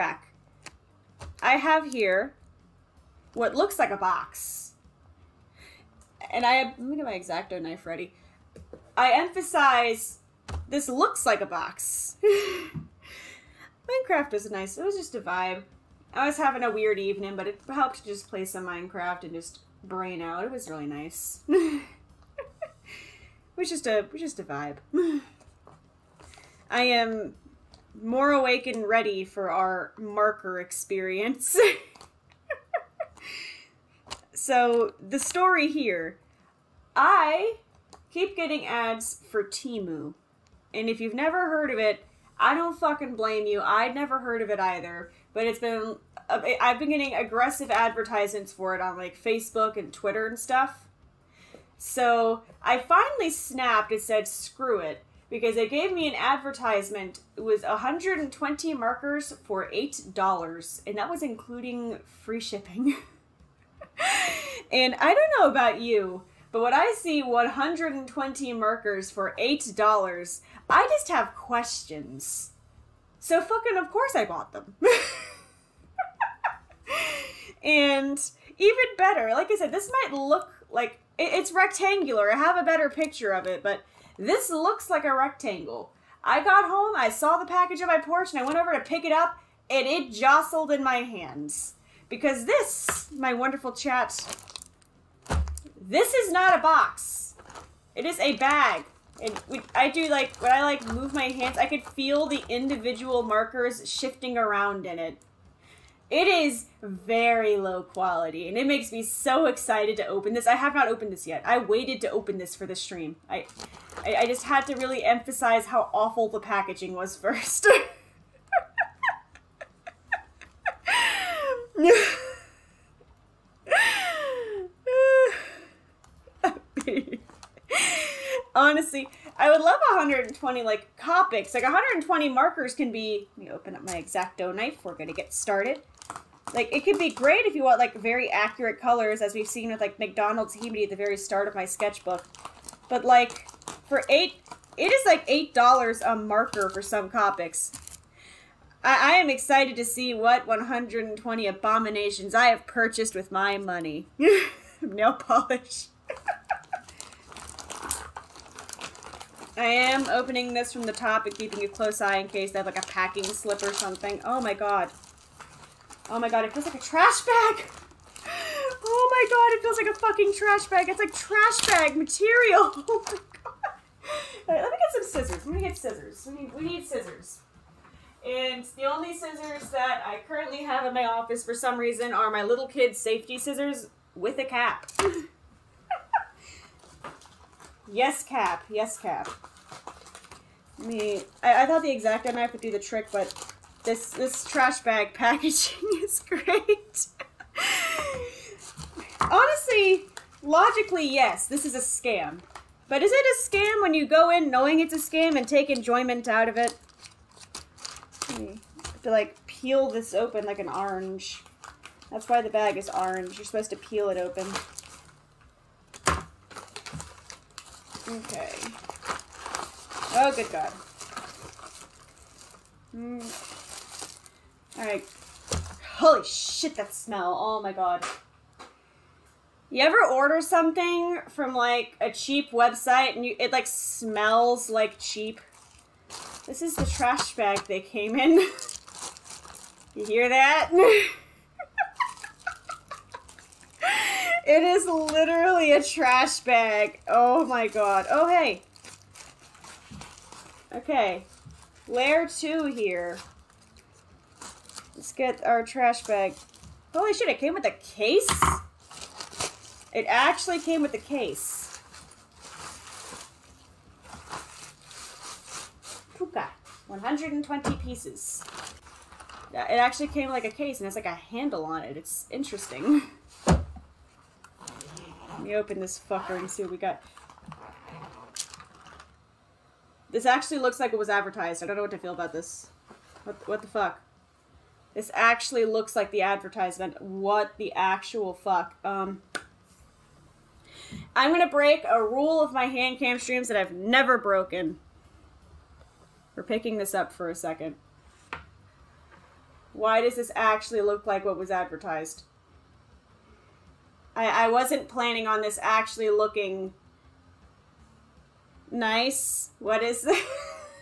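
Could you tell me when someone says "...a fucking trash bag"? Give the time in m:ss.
2:49.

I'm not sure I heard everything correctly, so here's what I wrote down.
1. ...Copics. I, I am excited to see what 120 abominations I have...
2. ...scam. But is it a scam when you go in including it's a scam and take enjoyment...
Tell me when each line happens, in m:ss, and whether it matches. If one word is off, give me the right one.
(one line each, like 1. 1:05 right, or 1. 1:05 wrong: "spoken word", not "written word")
1. 2:27 right
2. 3:21 wrong: "knowing", not "including".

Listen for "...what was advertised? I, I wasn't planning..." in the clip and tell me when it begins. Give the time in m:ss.
5:01.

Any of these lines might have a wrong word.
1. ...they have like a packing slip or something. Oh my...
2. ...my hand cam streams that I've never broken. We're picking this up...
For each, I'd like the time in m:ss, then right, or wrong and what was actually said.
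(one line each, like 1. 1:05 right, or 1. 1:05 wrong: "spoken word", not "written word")
1. 2:42 right
2. 4:52 right.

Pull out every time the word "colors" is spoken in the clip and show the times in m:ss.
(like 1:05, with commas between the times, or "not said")
2:18.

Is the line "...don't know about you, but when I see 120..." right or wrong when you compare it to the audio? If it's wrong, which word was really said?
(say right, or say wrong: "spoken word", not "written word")
right.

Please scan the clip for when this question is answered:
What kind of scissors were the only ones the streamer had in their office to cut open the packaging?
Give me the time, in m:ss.
3:02.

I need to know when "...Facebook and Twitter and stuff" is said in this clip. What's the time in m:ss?
0:49.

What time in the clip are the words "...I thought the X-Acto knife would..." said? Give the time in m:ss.
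3:11.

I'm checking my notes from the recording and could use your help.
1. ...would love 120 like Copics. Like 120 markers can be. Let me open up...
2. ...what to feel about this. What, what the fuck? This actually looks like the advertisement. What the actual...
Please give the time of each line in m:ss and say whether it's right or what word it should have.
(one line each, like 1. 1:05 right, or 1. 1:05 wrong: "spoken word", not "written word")
1. 2:09 right
2. 4:41 right.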